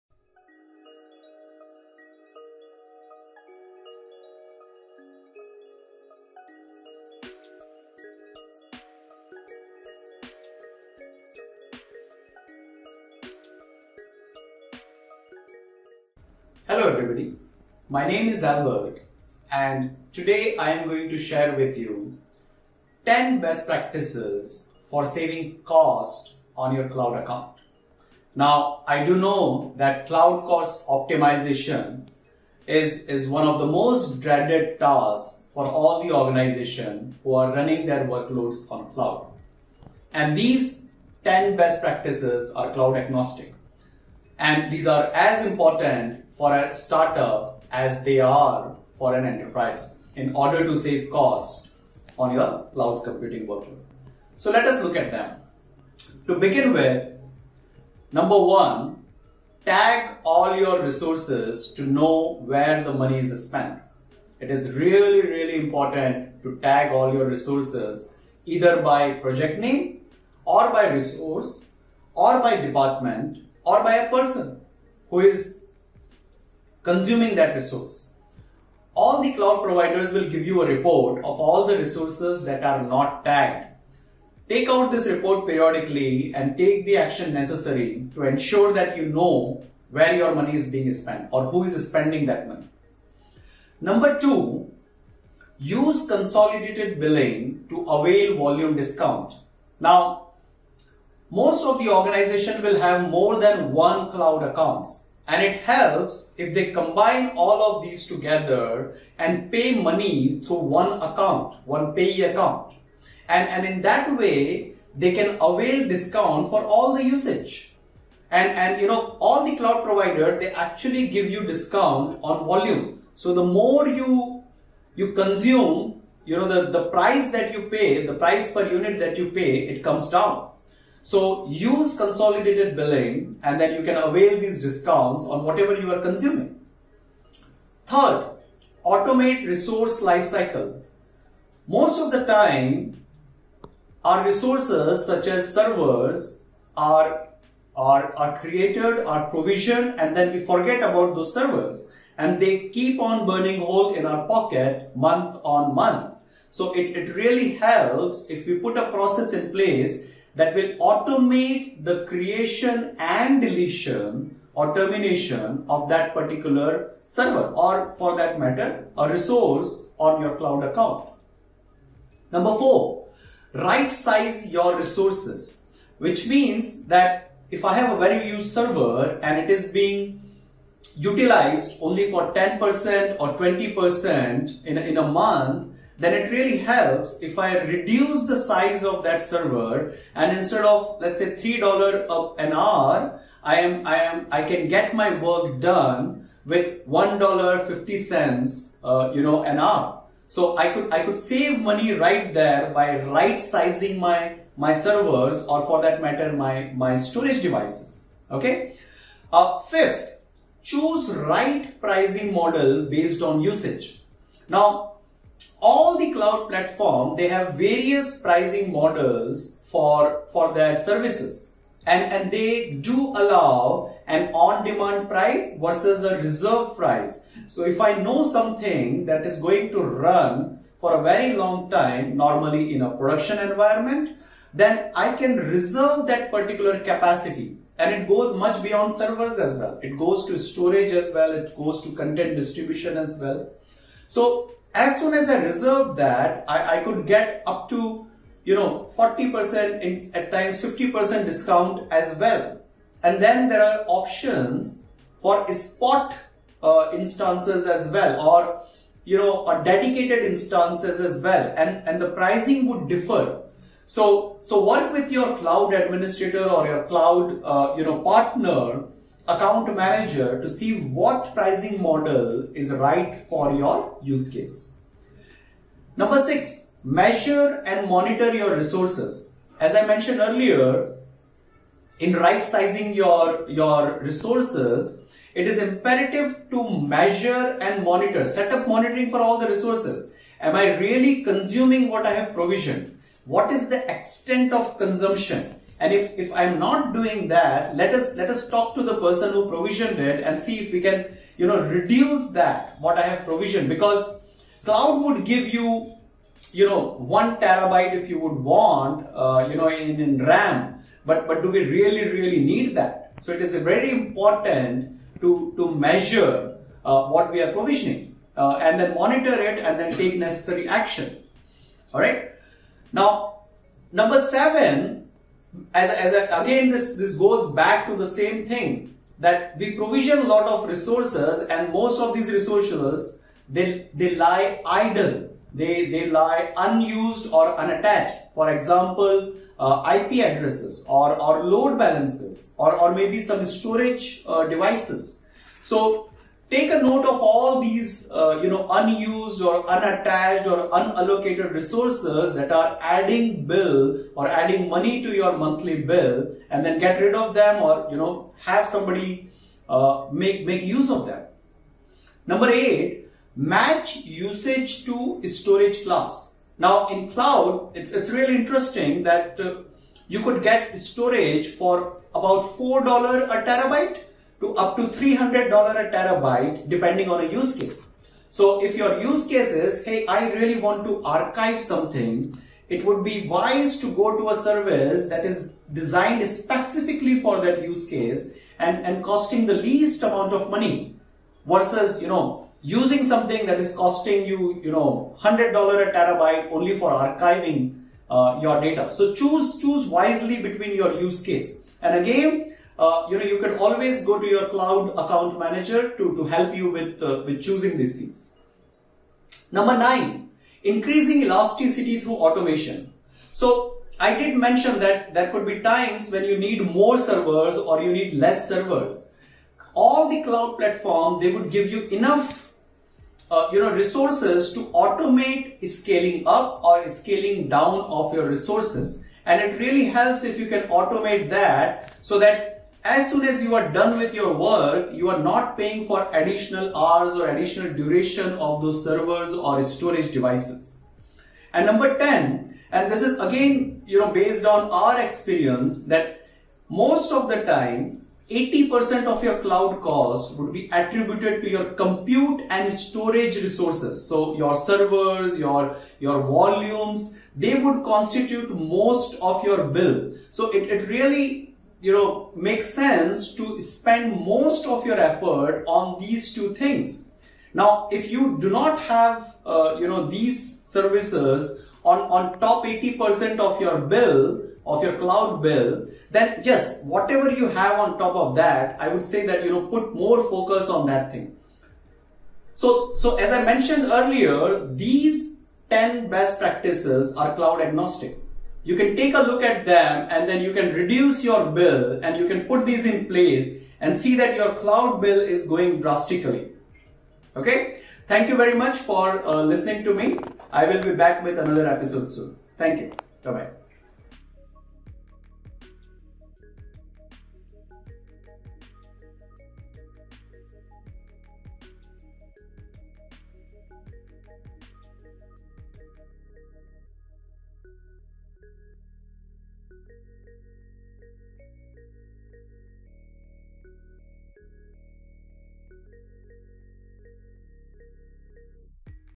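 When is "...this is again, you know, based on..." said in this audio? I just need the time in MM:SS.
07:22.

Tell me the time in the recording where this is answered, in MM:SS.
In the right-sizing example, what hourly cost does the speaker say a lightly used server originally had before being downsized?
03:11.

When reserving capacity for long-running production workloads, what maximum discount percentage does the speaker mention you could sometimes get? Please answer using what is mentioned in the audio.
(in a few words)
50%.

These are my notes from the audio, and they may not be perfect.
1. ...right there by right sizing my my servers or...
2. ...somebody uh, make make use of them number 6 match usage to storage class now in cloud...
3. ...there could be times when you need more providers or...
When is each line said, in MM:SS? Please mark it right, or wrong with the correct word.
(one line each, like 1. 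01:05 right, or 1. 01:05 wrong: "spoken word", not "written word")
1. 03:21 right
2. 05:58 wrong: "8", not "6"
3. 06:55 wrong: "servers", not "providers".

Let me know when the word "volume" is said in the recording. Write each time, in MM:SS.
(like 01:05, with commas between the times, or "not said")
01:38, 02:02, 07:36.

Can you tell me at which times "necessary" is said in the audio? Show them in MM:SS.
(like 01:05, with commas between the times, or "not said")
01:27, 05:20.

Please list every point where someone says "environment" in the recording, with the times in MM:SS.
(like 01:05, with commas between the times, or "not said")
03:53.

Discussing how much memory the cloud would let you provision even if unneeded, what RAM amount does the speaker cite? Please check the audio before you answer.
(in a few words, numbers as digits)
1 terabyte.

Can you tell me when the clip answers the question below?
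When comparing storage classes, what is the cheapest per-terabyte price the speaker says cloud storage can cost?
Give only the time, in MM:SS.
06:12.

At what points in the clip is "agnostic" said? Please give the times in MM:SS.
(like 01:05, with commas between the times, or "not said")
00:42, 08:07.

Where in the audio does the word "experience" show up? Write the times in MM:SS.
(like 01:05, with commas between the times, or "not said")
07:25.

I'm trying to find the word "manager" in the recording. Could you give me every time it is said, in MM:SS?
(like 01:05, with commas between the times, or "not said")
04:29, 06:45.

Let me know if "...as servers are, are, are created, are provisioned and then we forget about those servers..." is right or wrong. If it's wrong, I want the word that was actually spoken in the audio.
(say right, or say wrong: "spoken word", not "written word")
right.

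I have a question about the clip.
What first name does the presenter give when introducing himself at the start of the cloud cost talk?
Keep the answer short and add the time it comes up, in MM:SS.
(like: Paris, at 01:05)
Albert, at 00:18.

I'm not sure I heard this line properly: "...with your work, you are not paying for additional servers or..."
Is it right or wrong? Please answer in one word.
wrong.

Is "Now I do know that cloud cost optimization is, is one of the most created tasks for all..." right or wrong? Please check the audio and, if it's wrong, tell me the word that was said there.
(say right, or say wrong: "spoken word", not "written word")
wrong: "dreaded", not "created".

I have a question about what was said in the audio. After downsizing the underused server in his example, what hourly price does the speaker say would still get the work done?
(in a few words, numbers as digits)
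$1.50.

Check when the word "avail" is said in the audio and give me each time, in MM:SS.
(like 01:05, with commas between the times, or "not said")
01:37, 01:55, 02:14.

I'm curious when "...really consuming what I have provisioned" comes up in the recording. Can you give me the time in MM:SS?
04:50.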